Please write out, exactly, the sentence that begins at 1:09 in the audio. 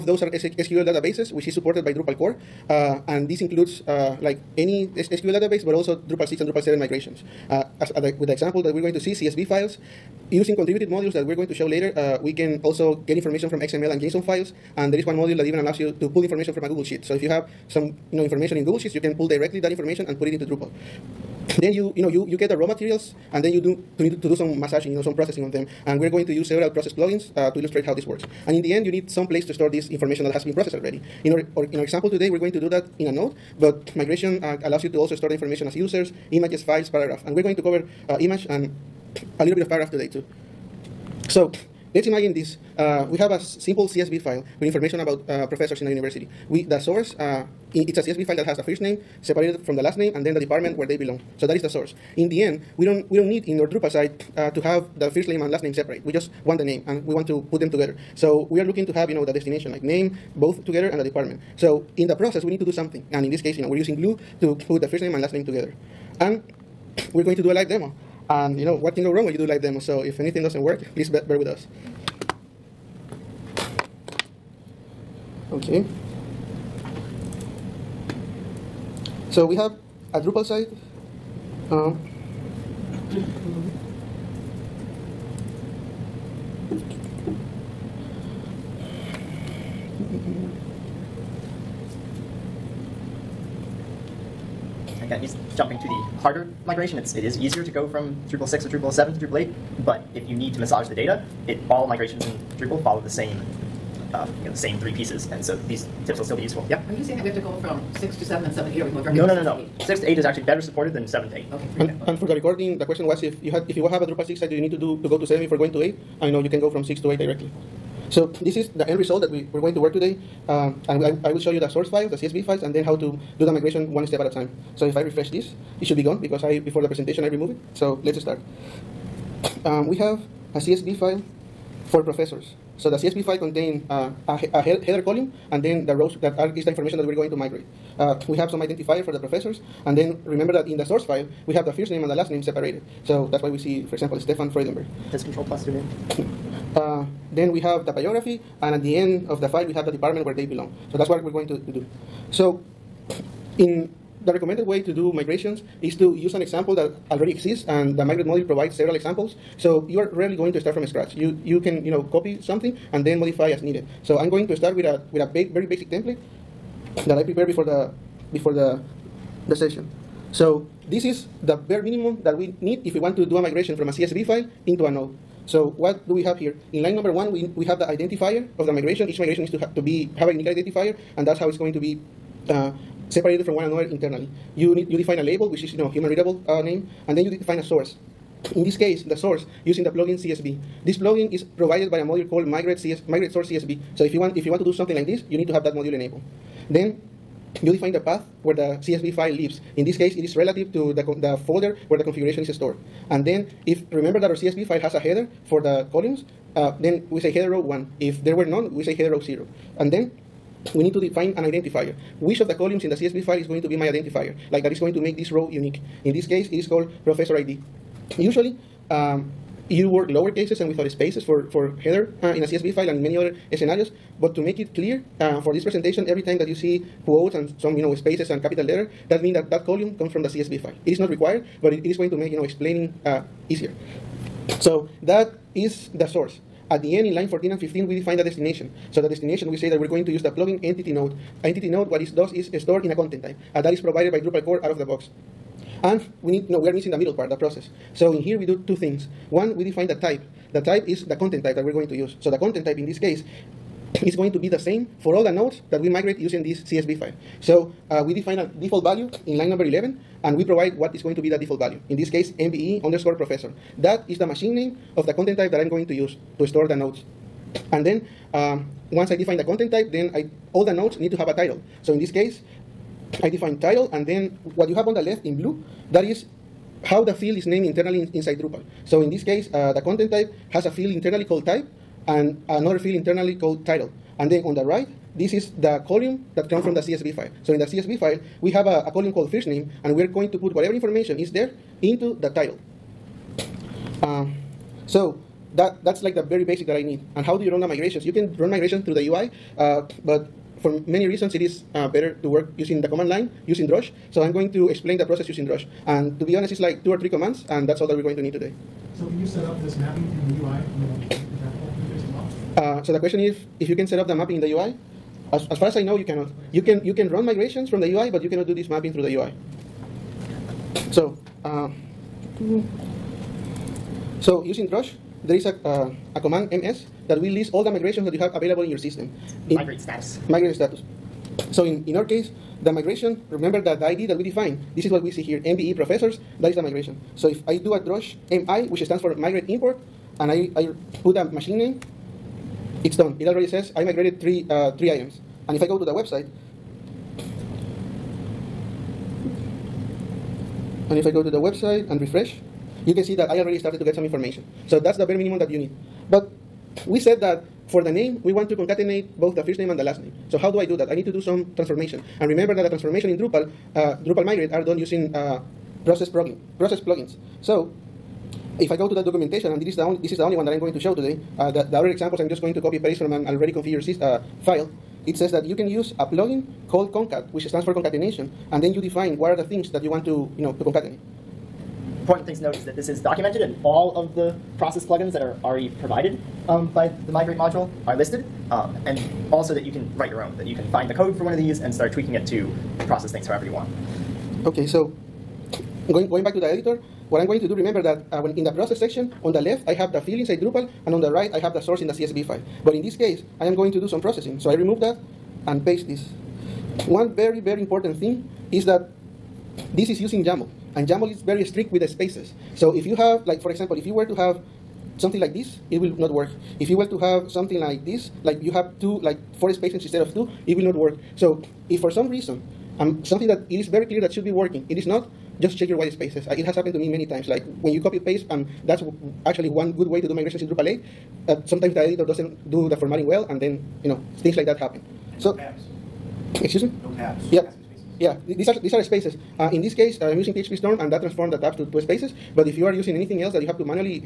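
So if anything doesn't work, please bear with us.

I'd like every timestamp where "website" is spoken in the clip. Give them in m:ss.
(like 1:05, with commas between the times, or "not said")
5:45, 5:51.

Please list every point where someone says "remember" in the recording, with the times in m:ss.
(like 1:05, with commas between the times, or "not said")
2:20, 3:23, 5:33, 6:02, 6:37.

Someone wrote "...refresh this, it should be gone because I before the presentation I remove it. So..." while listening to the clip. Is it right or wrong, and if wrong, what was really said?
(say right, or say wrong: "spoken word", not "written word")
right.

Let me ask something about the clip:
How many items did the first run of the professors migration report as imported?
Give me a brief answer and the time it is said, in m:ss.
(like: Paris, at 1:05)
3, at 5:44.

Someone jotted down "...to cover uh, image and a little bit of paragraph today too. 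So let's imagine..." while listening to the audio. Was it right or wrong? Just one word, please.
right.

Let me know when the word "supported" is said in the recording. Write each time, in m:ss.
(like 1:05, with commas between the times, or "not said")
0:01, 1:50.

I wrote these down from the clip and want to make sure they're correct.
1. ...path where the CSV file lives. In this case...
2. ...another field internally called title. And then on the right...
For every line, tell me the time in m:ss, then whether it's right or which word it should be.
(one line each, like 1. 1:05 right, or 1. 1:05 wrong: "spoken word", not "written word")
1. 3:17 right
2. 4:42 right.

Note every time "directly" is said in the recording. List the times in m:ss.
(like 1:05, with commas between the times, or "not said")
0:19, 1:49, 1:57.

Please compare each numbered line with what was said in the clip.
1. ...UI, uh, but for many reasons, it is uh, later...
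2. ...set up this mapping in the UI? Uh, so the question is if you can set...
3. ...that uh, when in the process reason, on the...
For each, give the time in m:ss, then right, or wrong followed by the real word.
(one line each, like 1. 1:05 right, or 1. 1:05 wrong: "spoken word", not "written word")
1. 4:59 wrong: "better", not "later"
2. 5:09 right
3. 6:37 wrong: "section", not "reason".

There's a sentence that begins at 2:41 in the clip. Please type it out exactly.
You you can you know copy something and then modify as needed.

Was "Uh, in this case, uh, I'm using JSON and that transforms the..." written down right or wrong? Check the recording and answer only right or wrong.
wrong.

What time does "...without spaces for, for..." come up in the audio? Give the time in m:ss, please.
3:40.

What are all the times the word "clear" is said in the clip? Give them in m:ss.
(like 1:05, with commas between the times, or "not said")
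3:44, 7:03.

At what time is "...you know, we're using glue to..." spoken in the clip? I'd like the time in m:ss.
1:03.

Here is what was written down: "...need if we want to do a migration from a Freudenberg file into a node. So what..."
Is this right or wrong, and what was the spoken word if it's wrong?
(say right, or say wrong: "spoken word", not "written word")
wrong: "CSV", not "Freudenberg".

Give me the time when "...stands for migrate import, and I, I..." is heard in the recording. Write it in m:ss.
5:38.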